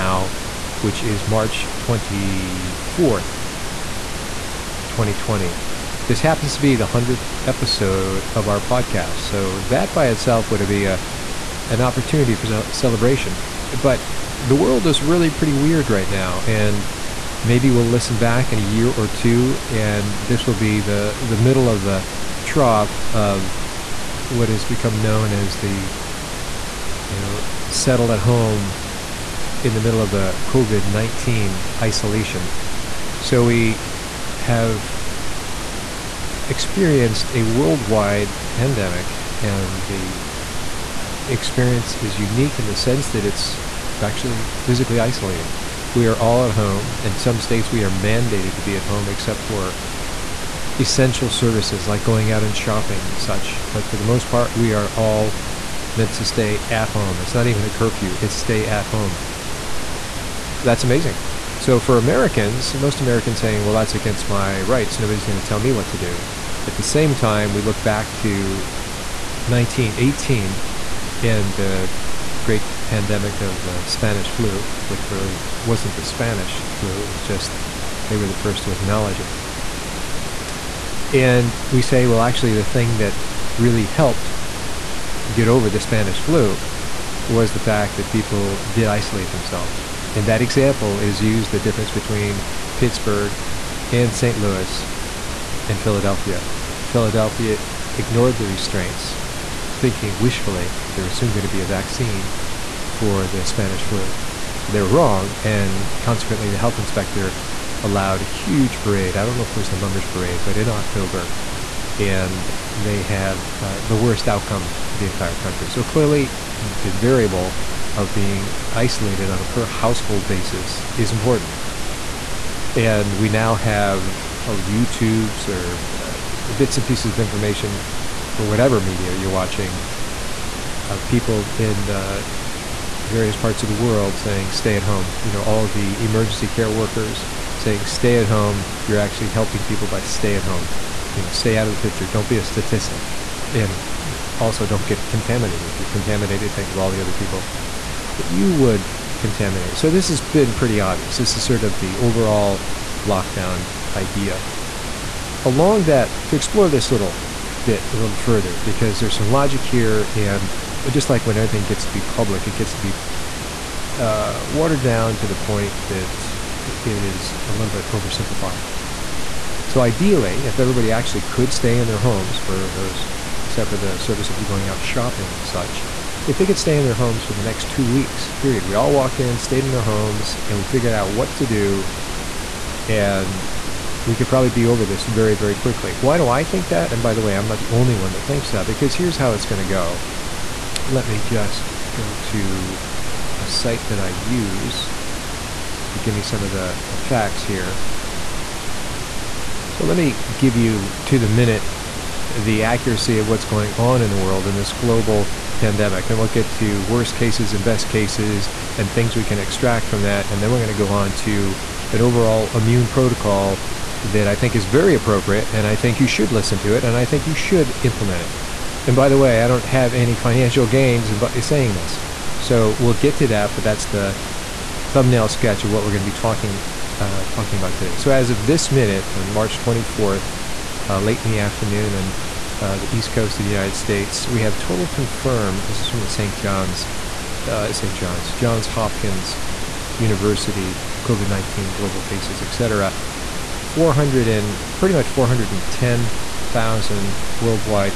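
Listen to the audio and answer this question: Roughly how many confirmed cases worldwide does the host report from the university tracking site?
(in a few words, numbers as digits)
410,000.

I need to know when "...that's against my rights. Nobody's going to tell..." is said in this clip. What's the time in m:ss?
1:03.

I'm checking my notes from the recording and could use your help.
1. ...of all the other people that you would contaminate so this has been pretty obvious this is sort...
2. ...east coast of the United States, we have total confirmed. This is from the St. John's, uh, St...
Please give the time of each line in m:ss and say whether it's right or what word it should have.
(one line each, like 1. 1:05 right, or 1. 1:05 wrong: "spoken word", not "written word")
1. 2:26 right
2. 3:52 right.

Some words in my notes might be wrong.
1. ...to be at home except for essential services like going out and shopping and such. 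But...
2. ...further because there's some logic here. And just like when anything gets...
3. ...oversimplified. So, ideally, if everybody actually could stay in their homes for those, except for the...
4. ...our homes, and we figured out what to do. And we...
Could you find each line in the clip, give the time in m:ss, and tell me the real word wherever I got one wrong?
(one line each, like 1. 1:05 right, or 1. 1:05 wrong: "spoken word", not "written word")
1. 0:48 right
2. 2:38 right
3. 2:47 right
4. 2:59 right.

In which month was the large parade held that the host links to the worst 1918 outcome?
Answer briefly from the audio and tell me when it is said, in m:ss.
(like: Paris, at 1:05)
October, at 1:50.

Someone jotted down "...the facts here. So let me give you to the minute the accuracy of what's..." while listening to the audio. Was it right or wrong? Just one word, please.
right.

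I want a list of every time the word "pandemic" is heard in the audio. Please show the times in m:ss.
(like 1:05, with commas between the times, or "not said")
0:38, 1:12, 3:25.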